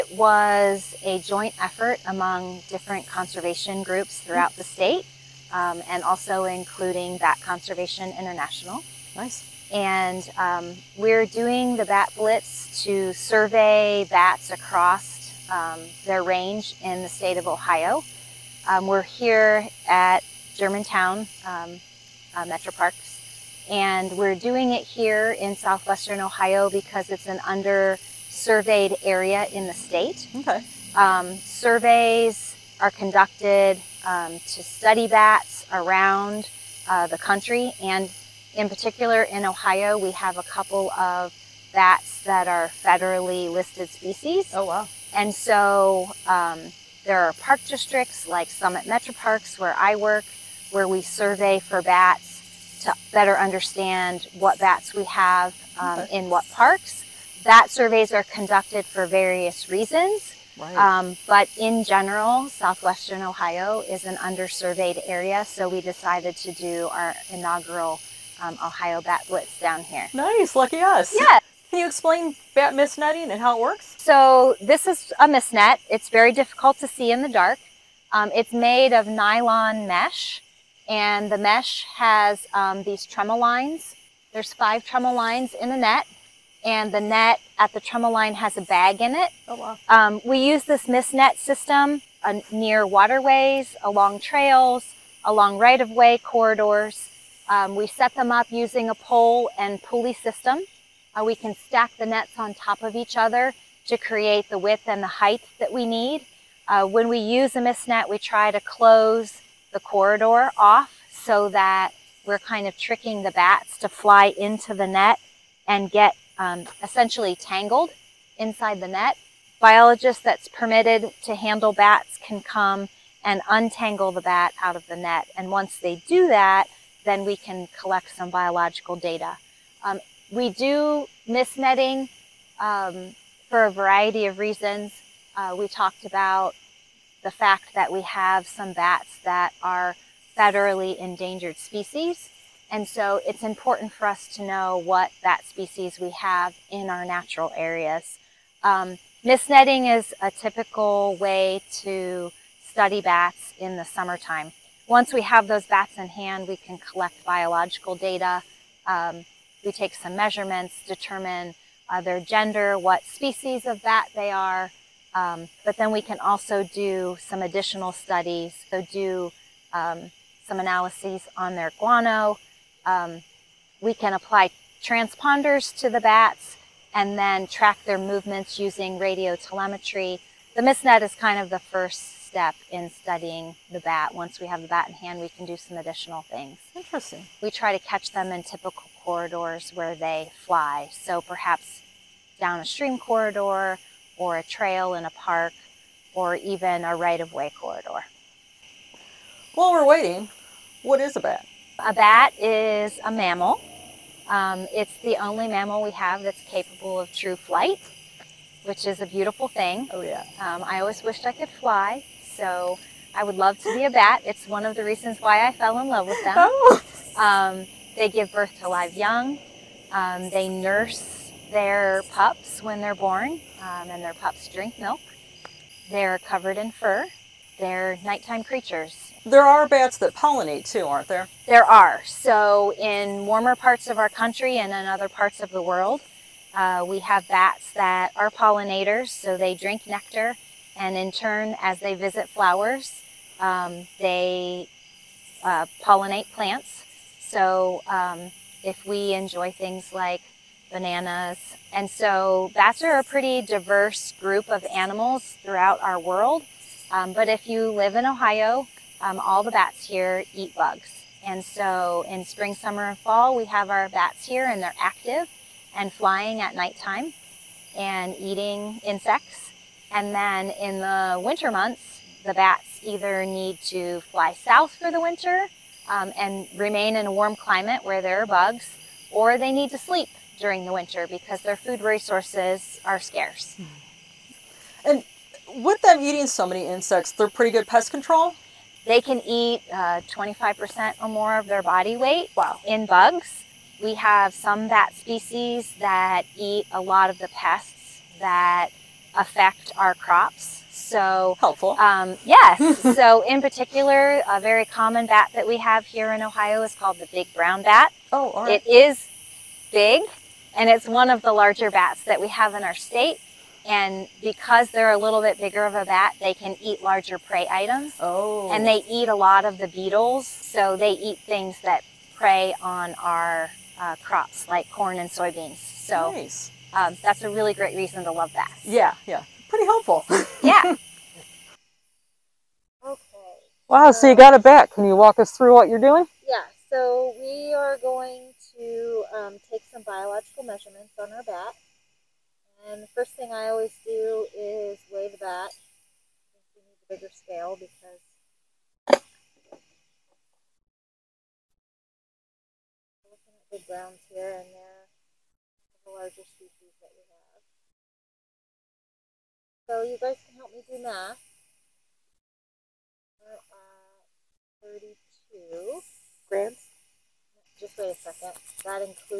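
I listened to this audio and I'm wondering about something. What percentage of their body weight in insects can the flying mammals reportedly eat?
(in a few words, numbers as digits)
25% or more.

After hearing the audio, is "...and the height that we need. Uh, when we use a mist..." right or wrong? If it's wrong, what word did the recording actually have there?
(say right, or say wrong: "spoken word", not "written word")
right.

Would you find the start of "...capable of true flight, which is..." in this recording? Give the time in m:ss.
3:26.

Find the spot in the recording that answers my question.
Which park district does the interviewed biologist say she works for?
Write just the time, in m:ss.
0:48.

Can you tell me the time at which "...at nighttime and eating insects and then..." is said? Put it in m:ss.
4:26.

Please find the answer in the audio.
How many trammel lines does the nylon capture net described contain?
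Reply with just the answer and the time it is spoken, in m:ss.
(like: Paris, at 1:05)
5, at 1:24.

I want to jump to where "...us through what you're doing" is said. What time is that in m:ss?
5:35.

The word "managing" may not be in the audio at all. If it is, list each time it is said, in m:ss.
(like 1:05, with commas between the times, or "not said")
not said.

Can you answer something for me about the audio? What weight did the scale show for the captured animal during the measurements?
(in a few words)
32 grams.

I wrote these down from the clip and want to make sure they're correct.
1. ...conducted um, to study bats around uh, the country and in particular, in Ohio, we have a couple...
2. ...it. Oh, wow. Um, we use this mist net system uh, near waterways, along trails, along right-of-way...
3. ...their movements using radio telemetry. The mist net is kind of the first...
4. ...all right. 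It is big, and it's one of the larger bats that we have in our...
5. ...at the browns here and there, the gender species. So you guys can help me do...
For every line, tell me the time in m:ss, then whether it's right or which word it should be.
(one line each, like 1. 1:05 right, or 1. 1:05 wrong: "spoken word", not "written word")
1. 0:32 right
2. 1:29 right
3. 2:57 right
4. 5:08 right
5. 5:53 wrong: "larger", not "gender".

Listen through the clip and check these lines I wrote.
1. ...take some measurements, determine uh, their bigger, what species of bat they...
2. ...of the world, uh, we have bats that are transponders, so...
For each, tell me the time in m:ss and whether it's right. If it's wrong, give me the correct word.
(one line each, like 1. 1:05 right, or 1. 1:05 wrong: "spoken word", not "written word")
1. 2:39 wrong: "gender", not "bigger"
2. 3:55 wrong: "pollinators", not "transponders".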